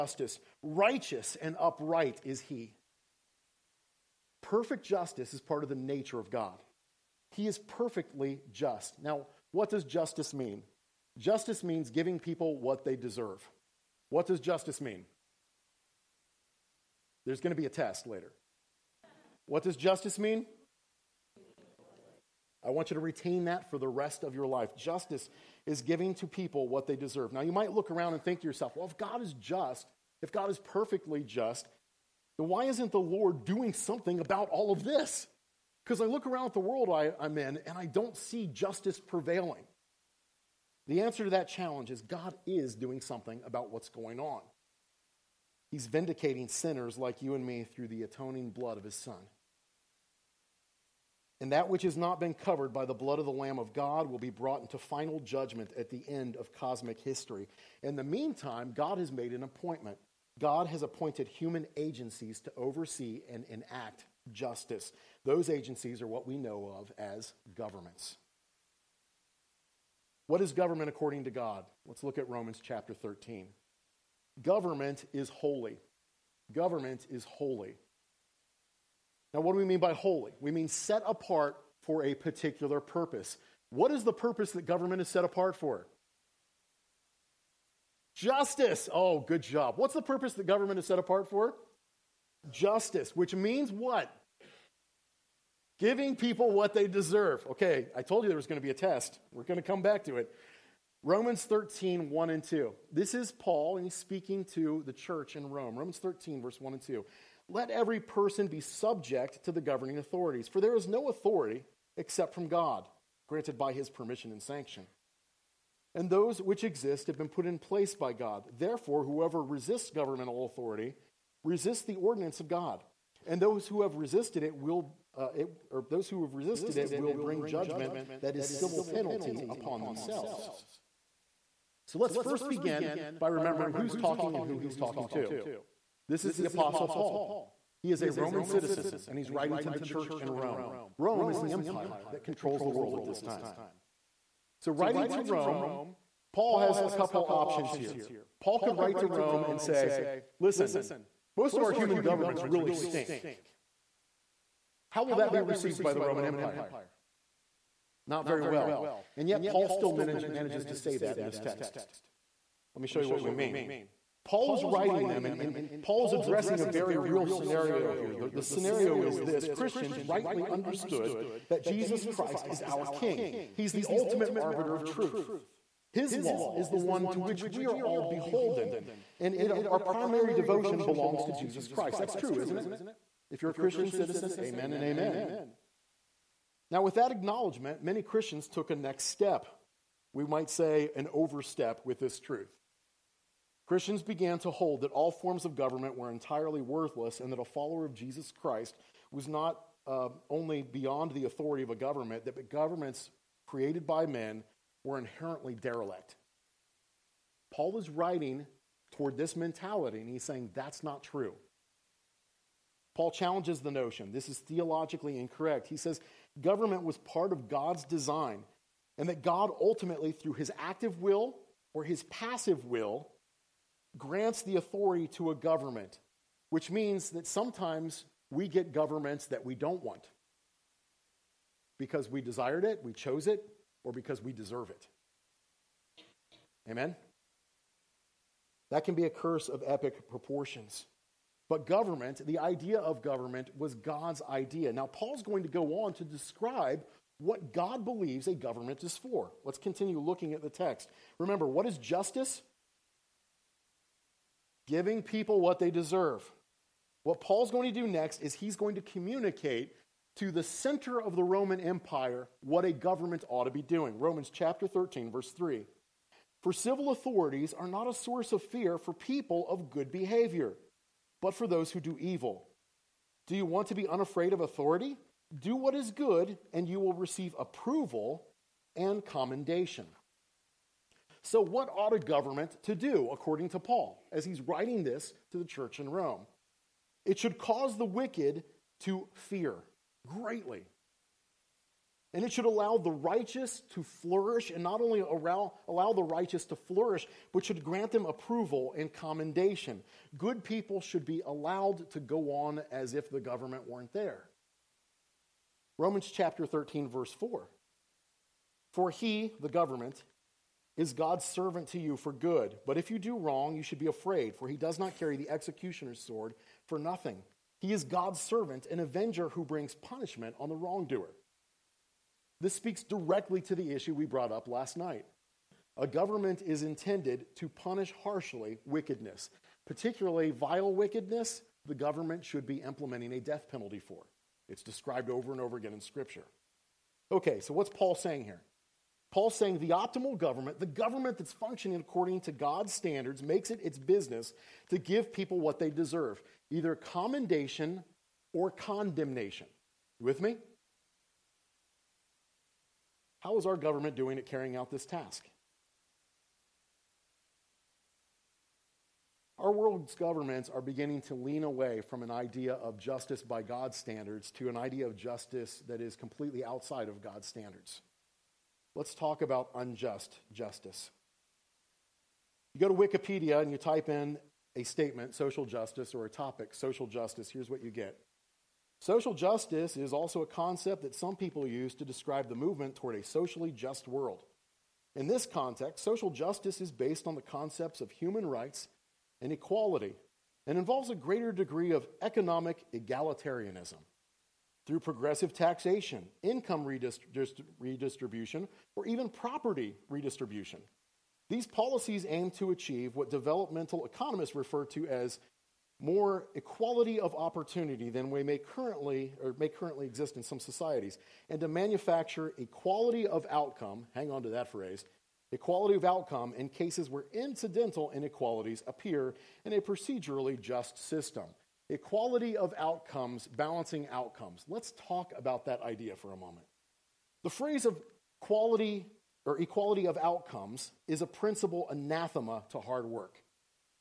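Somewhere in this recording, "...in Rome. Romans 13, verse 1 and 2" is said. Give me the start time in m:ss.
1:45.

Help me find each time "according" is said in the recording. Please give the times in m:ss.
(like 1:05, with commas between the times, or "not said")
1:10, 4:43, 5:41.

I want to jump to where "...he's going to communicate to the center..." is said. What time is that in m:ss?
4:18.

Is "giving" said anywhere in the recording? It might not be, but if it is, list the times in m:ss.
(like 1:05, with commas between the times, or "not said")
0:11, 0:25, 1:35, 4:14.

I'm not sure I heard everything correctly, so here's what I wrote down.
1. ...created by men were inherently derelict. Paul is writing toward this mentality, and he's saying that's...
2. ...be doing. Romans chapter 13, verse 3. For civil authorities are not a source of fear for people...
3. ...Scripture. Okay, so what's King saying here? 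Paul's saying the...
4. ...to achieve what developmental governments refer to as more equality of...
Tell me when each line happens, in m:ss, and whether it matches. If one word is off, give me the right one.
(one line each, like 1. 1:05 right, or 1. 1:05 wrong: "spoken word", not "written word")
1. 3:23 right
2. 4:23 right
3. 5:35 wrong: "Paul", not "King"
4. 6:42 wrong: "economists", not "governments".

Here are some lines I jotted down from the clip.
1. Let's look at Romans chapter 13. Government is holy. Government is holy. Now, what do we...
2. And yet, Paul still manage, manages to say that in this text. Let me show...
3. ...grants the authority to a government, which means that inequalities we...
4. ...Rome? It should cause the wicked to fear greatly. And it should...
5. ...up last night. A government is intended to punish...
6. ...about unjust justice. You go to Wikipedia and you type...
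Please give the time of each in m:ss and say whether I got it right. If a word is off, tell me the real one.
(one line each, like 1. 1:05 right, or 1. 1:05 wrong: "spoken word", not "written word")
1. 1:11 right
2. 2:39 right
3. 3:43 wrong: "sometimes", not "inequalities"
4. 4:45 right
5. 5:24 right
6. 6:09 right.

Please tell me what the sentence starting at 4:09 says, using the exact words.
Let's continue looking at the text.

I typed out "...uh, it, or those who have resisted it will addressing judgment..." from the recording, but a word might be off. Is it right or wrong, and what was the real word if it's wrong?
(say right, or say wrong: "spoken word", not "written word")
wrong: "bring", not "addressing".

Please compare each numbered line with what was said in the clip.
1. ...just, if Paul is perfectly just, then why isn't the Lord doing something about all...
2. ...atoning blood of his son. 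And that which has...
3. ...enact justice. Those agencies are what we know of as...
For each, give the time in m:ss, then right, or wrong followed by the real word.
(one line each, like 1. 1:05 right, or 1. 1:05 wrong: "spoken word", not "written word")
1. 0:29 wrong: "God", not "Paul"
2. 0:48 right
3. 1:03 right.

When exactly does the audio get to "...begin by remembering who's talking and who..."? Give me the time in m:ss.
2:12.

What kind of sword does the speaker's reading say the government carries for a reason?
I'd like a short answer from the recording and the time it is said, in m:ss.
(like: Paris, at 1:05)
Executioner's sword, at 5:15.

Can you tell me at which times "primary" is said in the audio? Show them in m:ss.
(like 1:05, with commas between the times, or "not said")
2:59.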